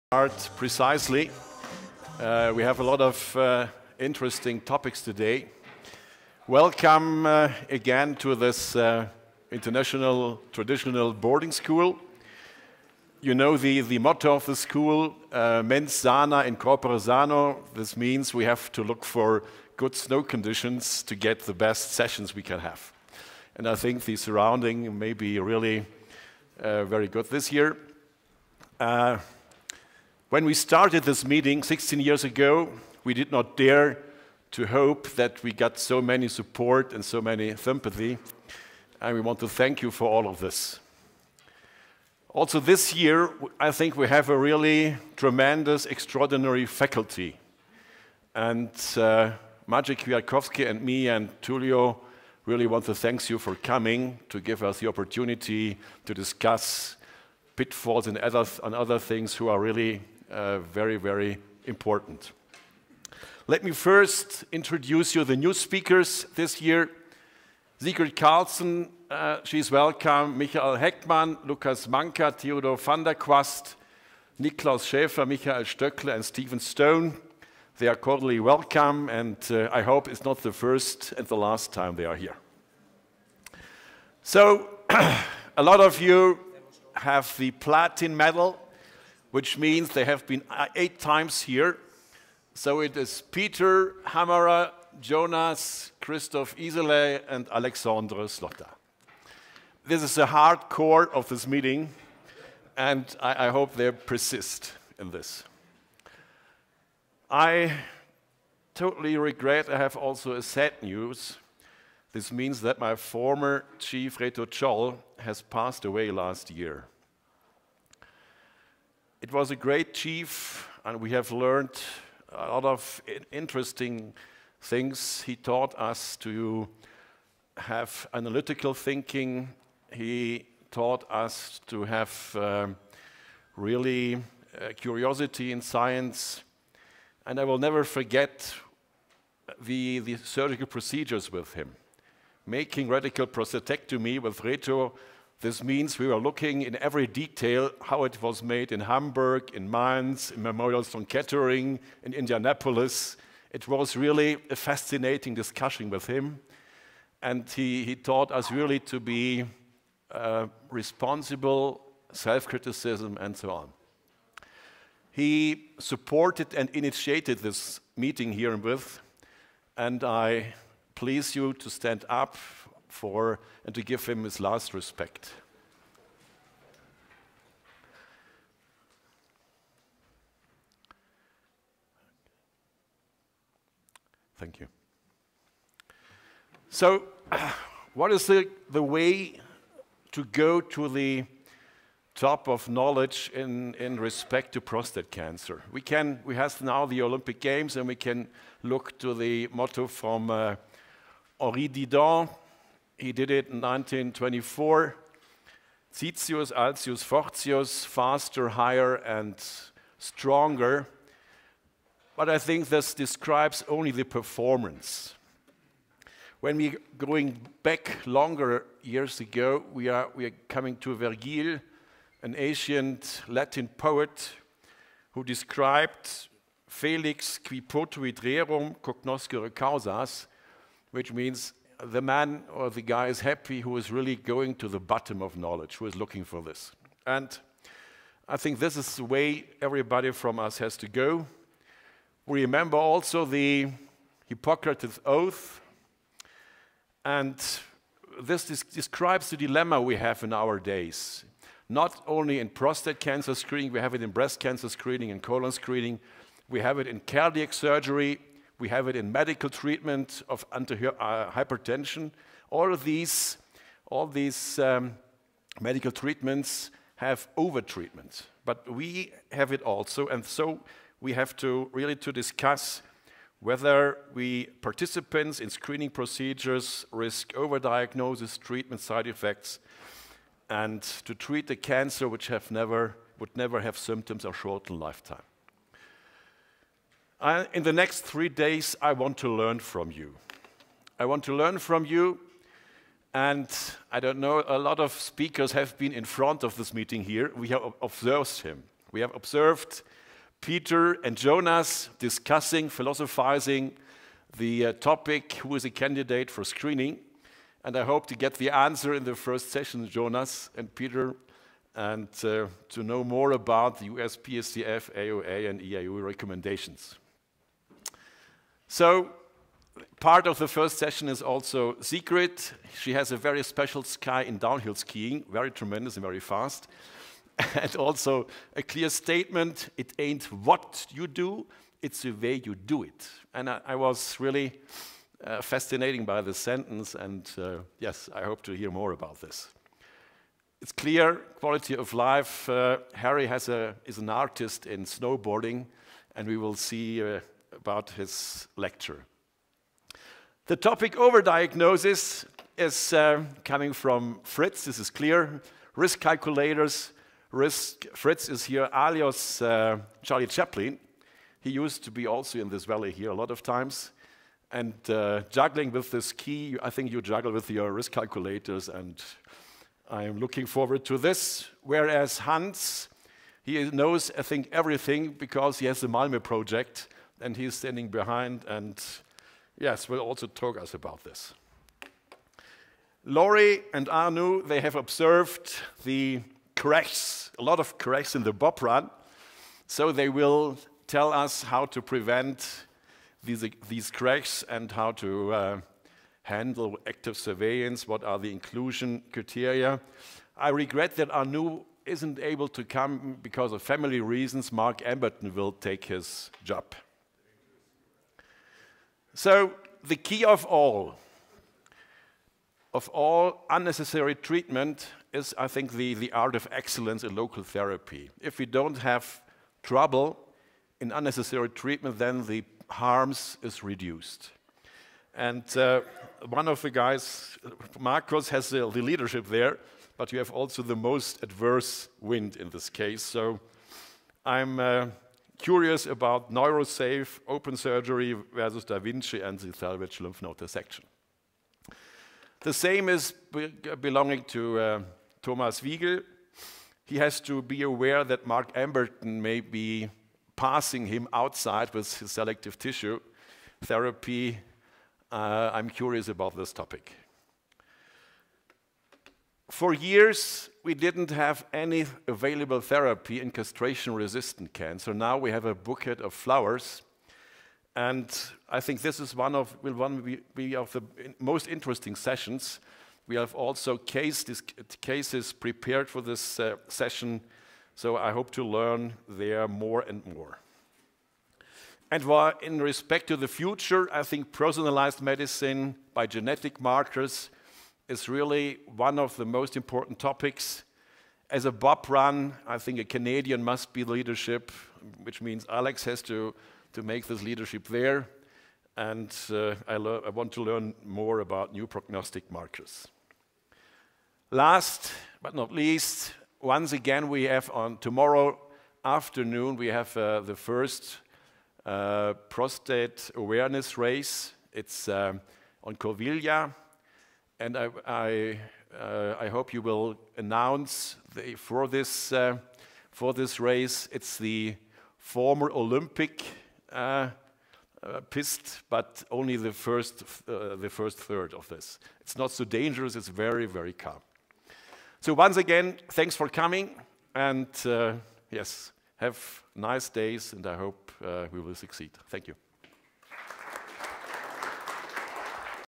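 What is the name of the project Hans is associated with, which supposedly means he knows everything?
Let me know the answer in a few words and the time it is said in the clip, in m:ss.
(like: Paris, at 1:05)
Malmö project, at 6:15.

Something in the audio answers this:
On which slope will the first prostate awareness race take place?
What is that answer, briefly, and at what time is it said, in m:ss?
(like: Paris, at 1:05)
Corviglia, at 8:35.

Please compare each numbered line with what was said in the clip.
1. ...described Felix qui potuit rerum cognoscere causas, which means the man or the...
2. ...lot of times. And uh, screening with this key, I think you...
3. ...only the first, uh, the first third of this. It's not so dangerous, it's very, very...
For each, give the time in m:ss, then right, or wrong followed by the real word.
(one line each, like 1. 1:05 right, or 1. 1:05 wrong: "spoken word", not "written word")
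1. 3:45 right
2. 6:03 wrong: "juggling", not "screening"
3. 8:49 right.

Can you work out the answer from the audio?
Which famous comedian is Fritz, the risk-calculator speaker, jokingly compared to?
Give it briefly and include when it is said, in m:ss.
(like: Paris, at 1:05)
Charlie Chaplin, at 6:00.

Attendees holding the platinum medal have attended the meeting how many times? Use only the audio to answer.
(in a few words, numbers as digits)
8.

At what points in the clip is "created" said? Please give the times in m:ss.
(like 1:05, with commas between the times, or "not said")
not said.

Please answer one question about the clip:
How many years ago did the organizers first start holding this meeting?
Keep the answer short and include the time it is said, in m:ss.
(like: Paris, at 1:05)
16, at 0:31.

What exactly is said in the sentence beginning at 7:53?
We have also case, this, cases prepared for this uh, session, so I hope to learn there more and more.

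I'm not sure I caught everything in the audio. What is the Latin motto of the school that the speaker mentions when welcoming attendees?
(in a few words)
mens sana in corpore sano.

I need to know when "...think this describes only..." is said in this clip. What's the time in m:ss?
3:32.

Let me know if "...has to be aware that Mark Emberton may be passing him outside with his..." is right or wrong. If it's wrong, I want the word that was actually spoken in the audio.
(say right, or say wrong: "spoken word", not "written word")
right.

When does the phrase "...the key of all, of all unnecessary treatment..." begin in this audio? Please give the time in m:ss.
6:49.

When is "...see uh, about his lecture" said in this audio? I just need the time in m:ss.
5:46.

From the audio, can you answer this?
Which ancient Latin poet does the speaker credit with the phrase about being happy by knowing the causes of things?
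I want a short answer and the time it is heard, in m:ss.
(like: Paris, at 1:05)
Vergil, at 3:40.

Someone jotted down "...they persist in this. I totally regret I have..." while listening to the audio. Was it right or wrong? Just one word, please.
right.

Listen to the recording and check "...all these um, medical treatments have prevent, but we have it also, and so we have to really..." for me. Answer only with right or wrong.
wrong.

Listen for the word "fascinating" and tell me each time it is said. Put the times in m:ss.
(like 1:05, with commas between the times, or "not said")
2:34, 5:35.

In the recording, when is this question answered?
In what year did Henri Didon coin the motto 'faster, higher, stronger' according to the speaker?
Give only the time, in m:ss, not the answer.
3:23.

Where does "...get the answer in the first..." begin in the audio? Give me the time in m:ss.
5:08.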